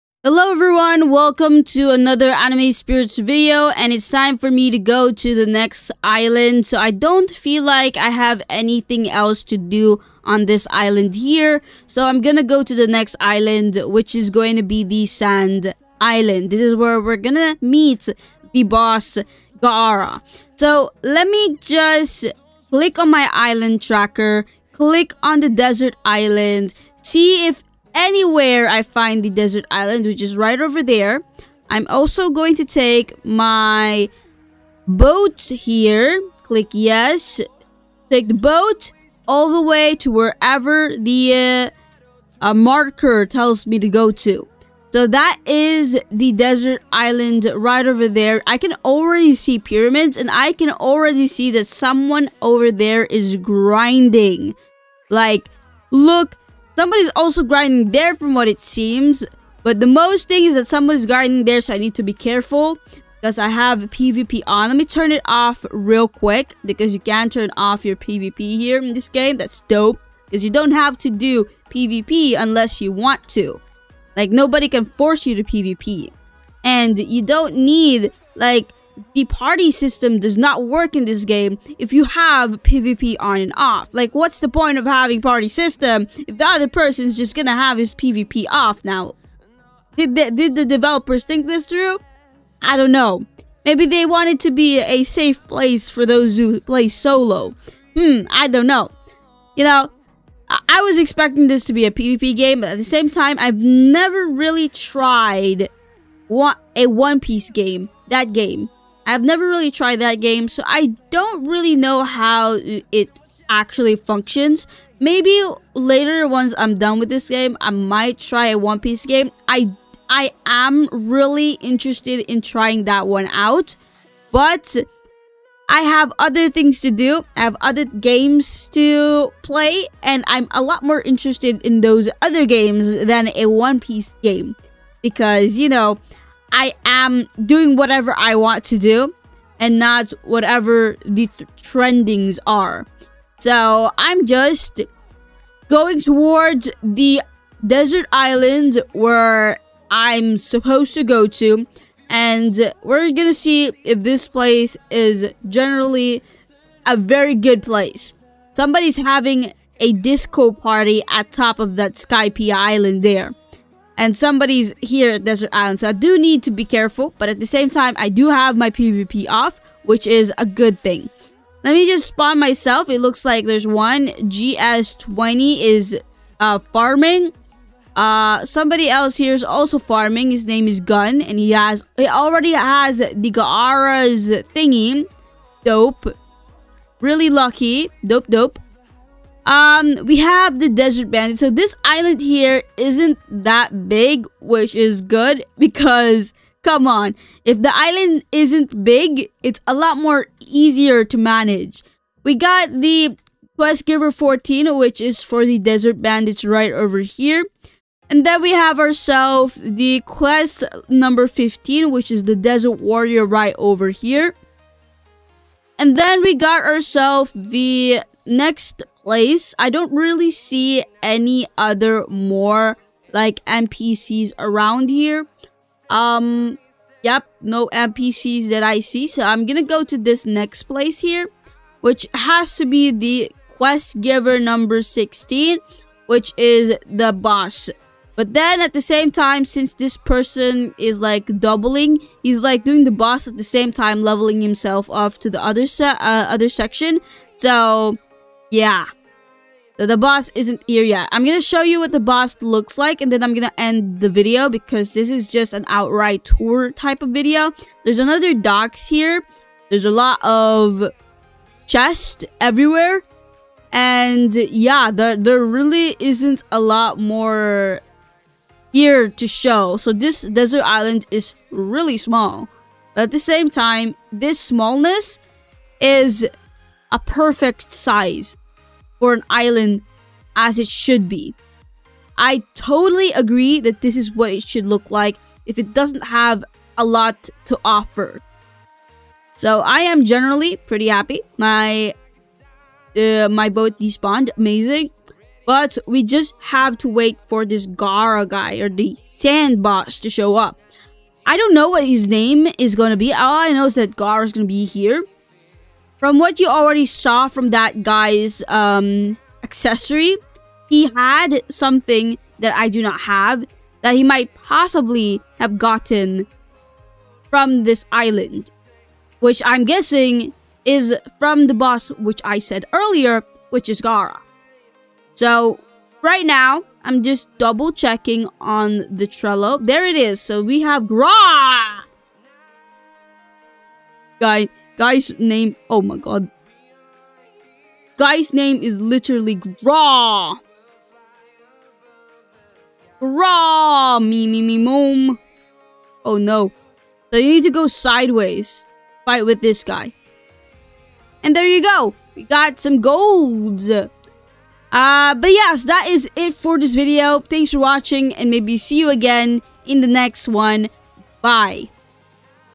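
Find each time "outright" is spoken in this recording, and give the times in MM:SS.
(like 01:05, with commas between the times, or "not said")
04:15.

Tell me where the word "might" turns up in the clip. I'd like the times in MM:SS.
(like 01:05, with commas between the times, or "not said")
01:57, 05:14.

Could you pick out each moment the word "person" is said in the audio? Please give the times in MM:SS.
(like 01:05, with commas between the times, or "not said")
01:26, 03:59.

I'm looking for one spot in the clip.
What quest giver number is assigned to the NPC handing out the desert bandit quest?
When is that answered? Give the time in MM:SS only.
03:24.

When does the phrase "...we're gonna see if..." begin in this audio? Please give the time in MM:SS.
02:32.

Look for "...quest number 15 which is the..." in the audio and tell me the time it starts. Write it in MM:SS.
03:30.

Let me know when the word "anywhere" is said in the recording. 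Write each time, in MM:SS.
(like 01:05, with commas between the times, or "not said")
00:27.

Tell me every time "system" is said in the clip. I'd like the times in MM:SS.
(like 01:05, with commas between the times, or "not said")
01:19, 01:25.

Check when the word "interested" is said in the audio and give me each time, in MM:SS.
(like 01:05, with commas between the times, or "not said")
02:01, 02:11.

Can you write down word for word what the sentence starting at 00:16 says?
This is where we're gonna meet the boss Gaara.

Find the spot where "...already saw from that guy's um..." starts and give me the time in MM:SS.
05:06.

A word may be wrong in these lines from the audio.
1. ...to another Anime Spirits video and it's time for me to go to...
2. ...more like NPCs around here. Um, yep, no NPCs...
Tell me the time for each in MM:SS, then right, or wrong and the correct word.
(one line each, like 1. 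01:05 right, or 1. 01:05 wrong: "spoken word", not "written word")
1. 00:01 right
2. 03:42 right.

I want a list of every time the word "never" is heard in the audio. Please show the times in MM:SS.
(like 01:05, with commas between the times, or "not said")
01:43, 01:49.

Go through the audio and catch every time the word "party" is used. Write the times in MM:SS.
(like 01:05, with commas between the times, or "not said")
01:19, 01:25, 02:40.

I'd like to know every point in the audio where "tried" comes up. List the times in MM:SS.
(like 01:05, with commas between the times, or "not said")
01:44, 01:49.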